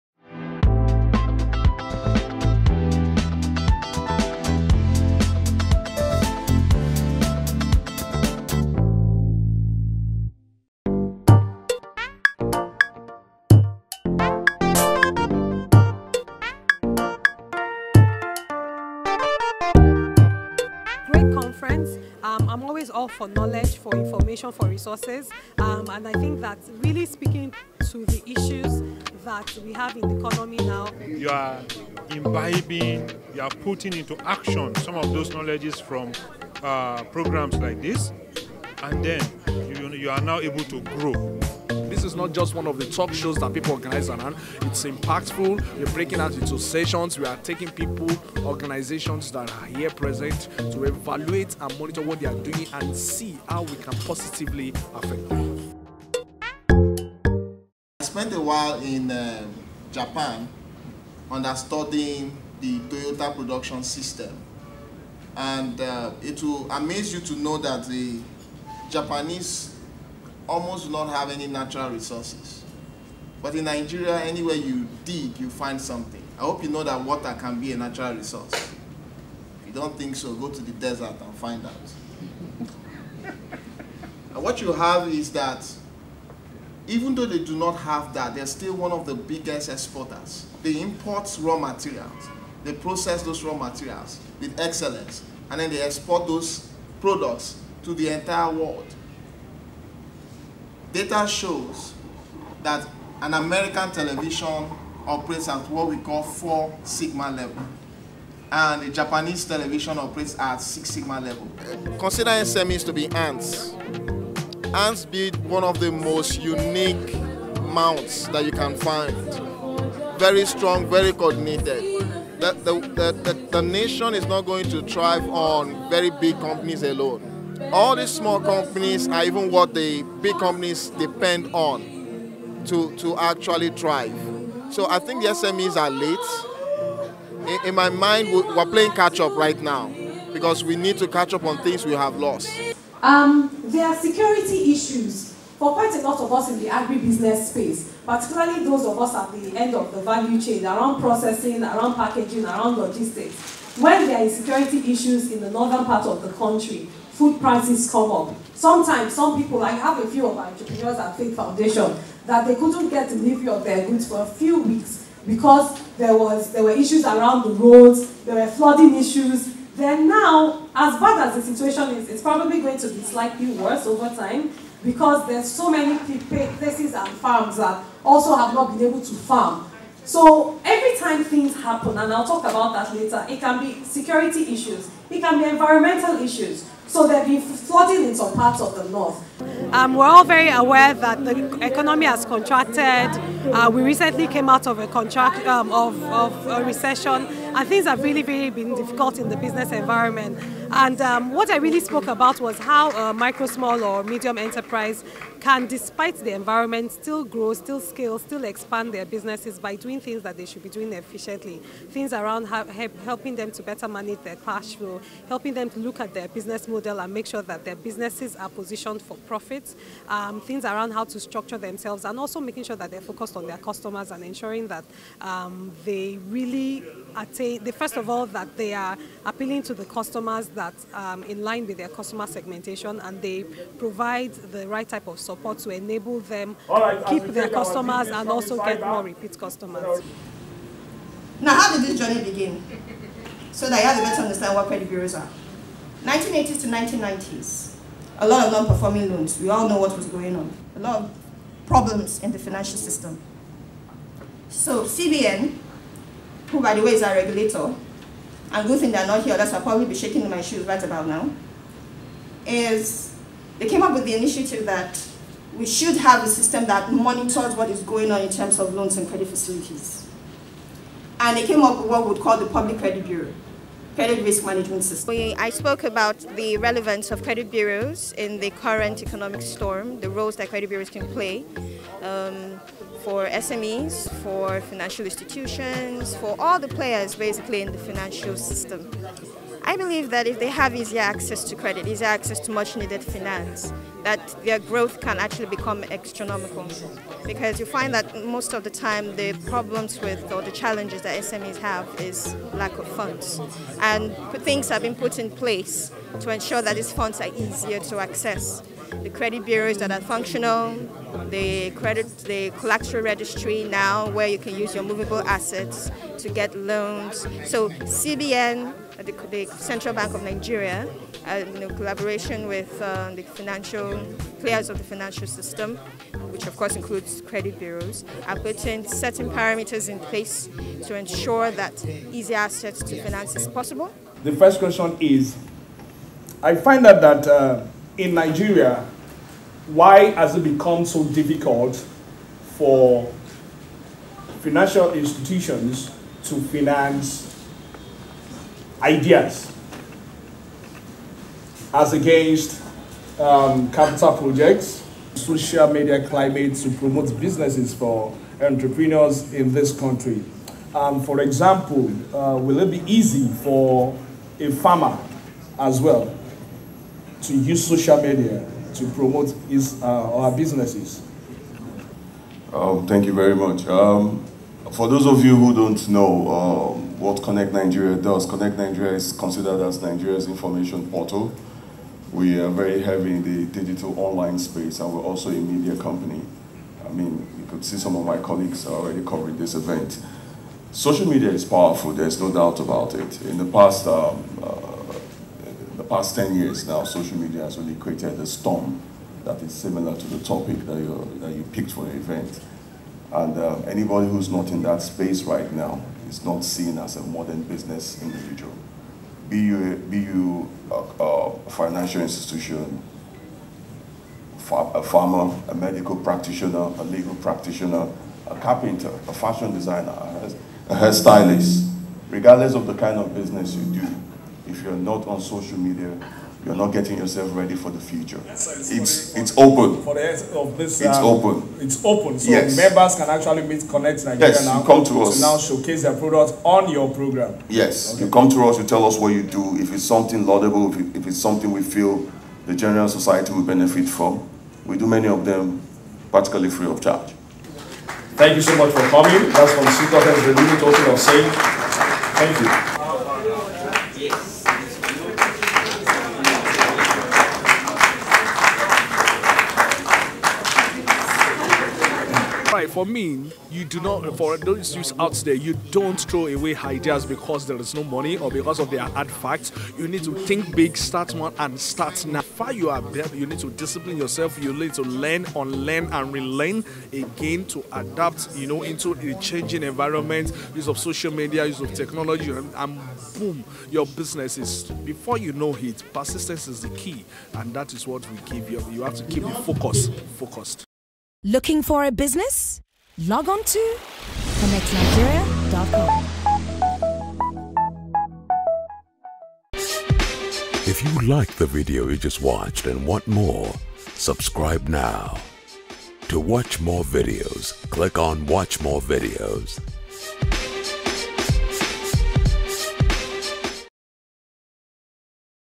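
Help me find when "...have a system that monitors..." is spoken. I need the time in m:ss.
4:25.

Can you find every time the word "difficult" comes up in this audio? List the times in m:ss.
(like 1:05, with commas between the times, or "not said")
3:18, 5:41.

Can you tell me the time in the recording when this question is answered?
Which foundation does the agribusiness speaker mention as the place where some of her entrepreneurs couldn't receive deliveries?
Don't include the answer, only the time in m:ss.
2:41.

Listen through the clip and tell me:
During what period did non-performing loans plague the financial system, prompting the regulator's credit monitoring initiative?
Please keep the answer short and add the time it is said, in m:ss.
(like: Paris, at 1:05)
1980s to 1990s, at 4:06.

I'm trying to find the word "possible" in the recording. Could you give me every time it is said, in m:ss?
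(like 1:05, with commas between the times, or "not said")
5:33.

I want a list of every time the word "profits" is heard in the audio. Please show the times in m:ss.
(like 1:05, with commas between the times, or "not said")
3:39.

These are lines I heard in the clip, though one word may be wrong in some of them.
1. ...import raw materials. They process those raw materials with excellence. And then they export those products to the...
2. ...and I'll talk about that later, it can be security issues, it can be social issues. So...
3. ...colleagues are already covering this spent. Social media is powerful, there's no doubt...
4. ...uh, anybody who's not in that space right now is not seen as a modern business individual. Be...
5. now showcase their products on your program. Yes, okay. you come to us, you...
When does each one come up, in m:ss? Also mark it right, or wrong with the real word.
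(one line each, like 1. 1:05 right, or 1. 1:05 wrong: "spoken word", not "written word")
1. 1:30 right
2. 3:01 wrong: "environmental", not "social"
3. 6:28 wrong: "event", not "spent"
4. 6:43 right
5. 7:15 right.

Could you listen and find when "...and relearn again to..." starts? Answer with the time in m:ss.
7:55.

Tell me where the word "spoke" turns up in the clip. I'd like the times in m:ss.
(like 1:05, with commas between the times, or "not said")
3:21, 4:35.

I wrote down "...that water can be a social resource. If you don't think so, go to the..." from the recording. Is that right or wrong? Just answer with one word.
wrong.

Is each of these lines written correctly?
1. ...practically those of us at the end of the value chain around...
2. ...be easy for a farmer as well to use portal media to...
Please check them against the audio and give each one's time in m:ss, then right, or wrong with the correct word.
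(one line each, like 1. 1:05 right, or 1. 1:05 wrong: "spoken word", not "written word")
1. 2:28 wrong: "particularly", not "practically"
2. 6:02 wrong: "social", not "portal".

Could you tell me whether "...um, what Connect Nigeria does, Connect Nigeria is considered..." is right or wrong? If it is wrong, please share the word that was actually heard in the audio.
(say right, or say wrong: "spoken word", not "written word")
right.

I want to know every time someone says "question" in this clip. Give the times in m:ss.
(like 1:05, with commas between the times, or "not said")
5:34.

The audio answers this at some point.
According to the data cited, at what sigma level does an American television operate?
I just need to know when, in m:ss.
1:46.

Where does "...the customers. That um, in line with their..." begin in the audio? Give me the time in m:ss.
3:49.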